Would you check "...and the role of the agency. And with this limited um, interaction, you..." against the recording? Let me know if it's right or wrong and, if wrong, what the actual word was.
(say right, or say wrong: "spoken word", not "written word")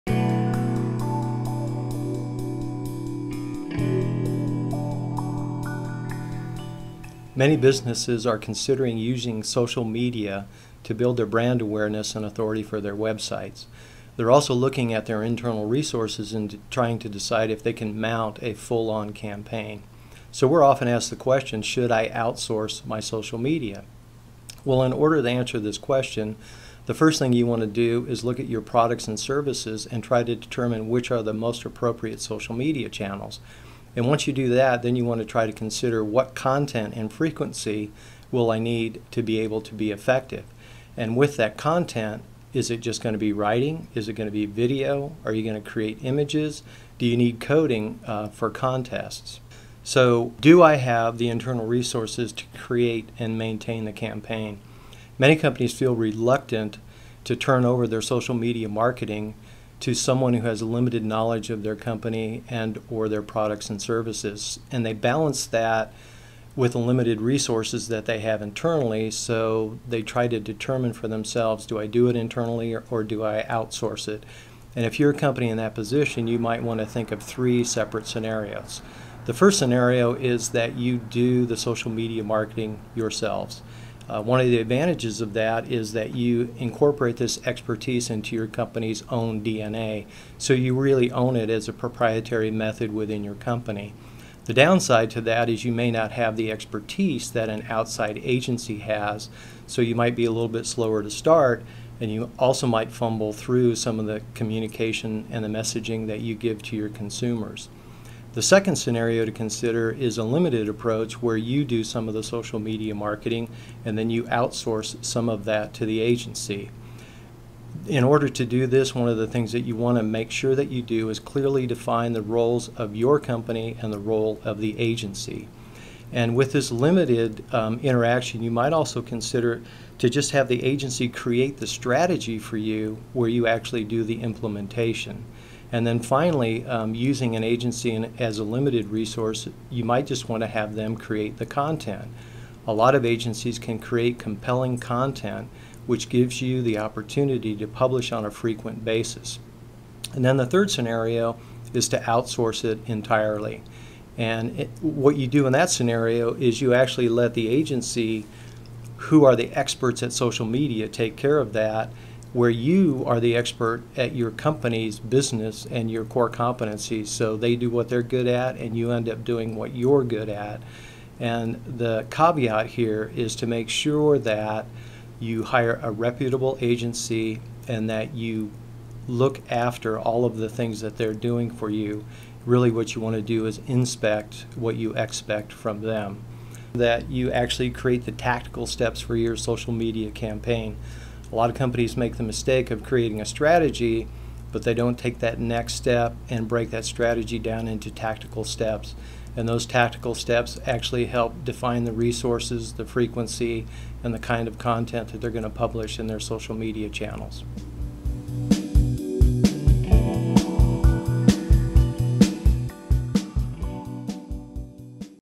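right.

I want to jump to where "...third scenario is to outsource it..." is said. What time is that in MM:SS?
02:30.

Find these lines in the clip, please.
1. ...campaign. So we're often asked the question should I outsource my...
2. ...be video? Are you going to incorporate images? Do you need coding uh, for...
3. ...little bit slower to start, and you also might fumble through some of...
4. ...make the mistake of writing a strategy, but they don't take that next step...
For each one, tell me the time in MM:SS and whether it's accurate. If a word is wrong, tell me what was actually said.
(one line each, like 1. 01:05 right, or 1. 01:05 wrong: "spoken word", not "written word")
1. 00:19 right
2. 00:44 wrong: "create", not "incorporate"
3. 01:40 right
4. 03:11 wrong: "creating", not "writing".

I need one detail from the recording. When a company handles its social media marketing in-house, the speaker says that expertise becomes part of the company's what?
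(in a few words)
DNA.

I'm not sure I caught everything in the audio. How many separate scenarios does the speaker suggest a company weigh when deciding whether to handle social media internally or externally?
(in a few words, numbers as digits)
3.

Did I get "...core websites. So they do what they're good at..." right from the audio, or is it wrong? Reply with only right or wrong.
wrong.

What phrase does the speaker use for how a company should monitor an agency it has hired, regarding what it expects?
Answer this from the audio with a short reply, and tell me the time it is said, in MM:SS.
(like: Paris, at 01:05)
Inspect what you expect, at 03:03.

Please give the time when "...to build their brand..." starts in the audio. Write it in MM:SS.
00:10.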